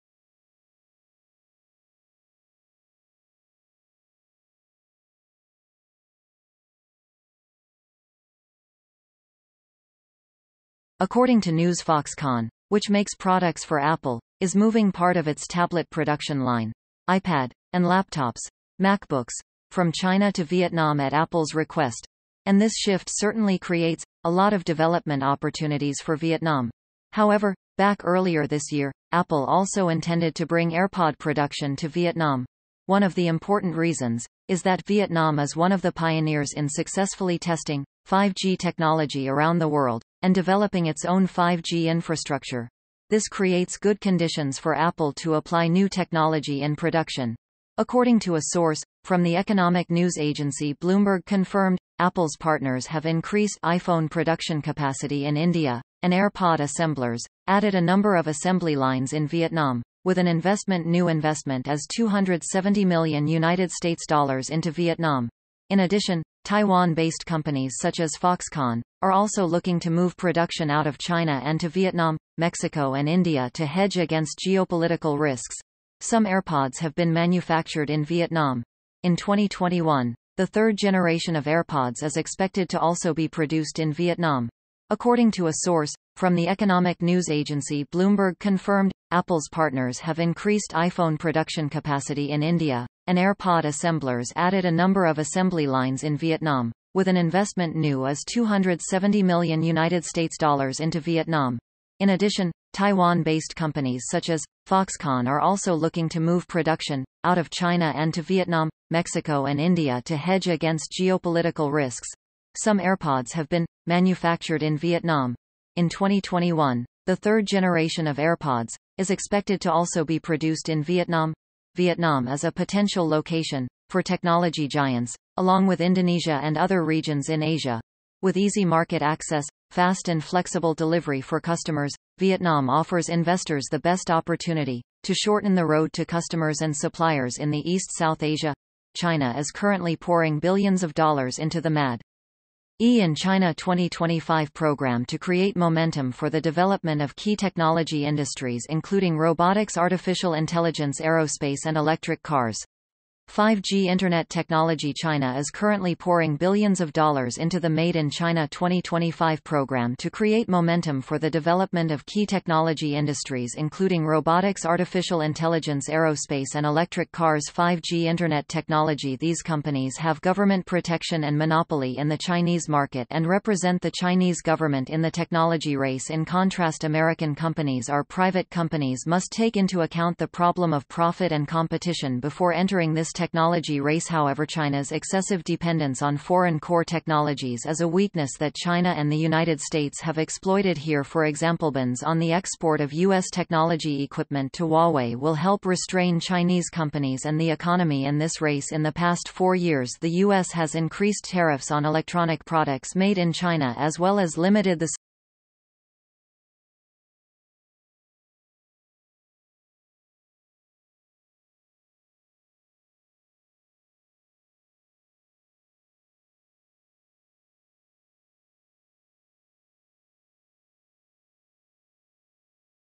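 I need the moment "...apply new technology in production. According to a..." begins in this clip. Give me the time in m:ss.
0:45.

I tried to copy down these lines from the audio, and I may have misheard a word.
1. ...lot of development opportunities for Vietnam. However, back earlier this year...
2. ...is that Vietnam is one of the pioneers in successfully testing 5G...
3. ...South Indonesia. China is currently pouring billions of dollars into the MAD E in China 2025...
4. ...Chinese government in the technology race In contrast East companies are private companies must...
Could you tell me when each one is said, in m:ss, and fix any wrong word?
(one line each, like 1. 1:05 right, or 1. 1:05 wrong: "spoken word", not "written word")
1. 0:24 right
2. 0:34 right
3. 2:17 wrong: "Asia", not "Indonesia"
4. 2:53 wrong: "American", not "East".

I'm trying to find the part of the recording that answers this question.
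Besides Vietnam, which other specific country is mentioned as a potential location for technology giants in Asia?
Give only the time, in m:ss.
2:05.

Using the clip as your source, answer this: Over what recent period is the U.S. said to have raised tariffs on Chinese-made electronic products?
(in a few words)
past 4 years.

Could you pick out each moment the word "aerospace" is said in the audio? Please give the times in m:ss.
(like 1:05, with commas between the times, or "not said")
2:30, 2:45.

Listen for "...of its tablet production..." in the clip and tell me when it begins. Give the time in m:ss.
0:15.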